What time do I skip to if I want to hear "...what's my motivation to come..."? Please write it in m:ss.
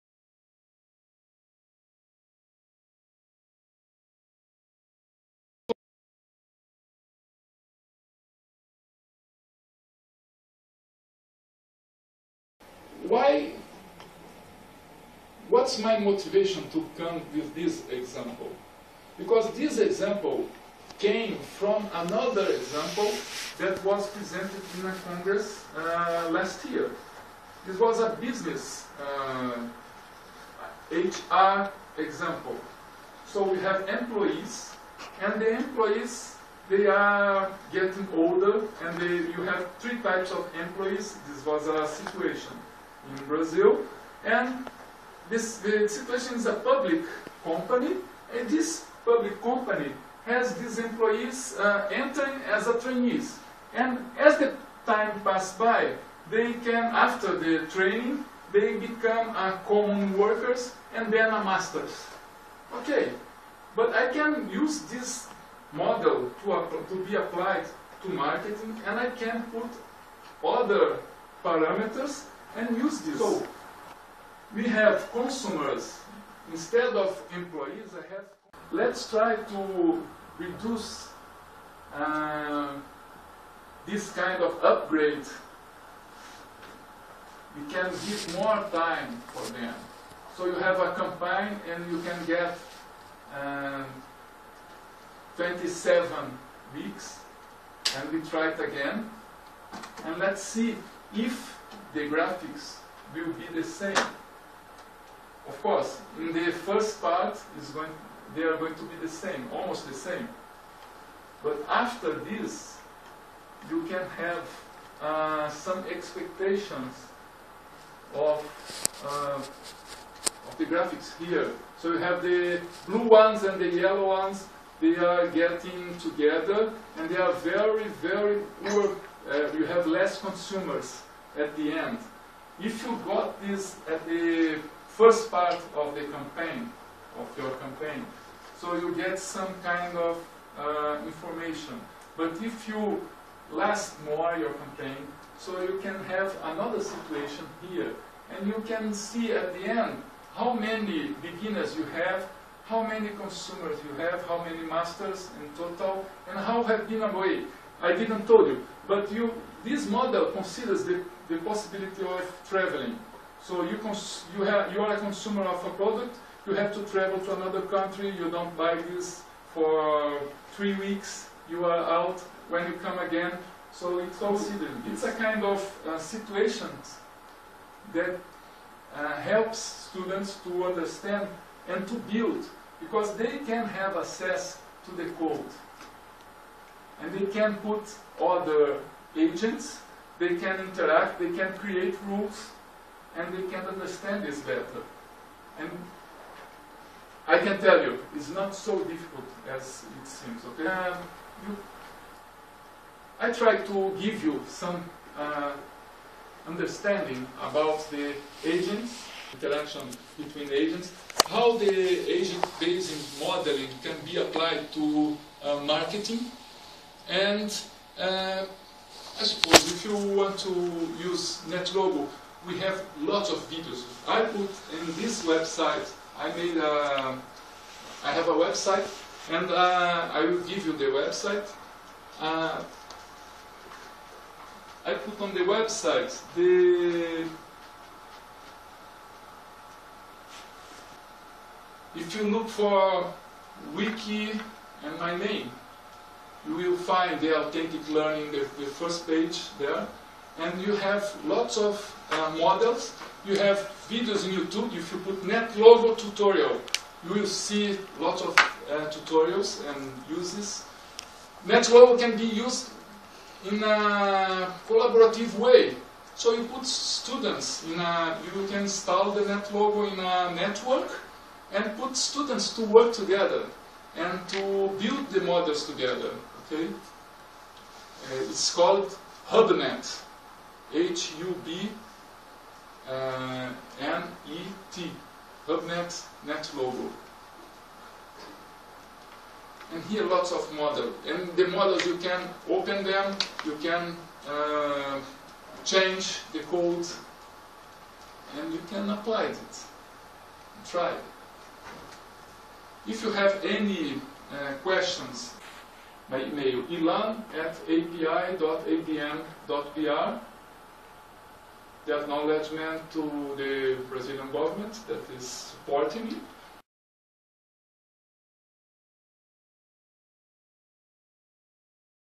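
0:15.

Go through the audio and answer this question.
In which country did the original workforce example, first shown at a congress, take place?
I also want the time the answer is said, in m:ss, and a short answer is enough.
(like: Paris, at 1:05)
Brazil, at 0:43.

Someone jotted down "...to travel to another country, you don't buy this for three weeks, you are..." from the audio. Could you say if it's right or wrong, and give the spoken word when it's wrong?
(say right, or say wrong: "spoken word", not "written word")
right.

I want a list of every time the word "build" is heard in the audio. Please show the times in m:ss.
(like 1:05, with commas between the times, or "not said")
3:02, 4:34.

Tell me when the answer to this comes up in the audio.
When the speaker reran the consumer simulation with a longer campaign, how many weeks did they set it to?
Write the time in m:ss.
1:35.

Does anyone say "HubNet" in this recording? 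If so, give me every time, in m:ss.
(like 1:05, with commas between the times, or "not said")
4:39, 4:45.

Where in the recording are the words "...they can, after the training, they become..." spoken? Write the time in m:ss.
0:56.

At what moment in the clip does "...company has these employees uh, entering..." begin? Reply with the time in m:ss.
0:49.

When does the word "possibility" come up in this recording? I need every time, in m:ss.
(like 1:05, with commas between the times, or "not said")
2:41.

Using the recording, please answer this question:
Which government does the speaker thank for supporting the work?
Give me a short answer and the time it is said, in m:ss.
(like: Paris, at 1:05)
Brazilian government, at 5:13.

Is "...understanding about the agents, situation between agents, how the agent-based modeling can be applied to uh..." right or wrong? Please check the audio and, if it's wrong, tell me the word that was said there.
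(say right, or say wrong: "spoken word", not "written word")
wrong: "interaction", not "situation".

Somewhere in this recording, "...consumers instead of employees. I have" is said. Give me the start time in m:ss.
1:15.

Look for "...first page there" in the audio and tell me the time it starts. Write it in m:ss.
4:08.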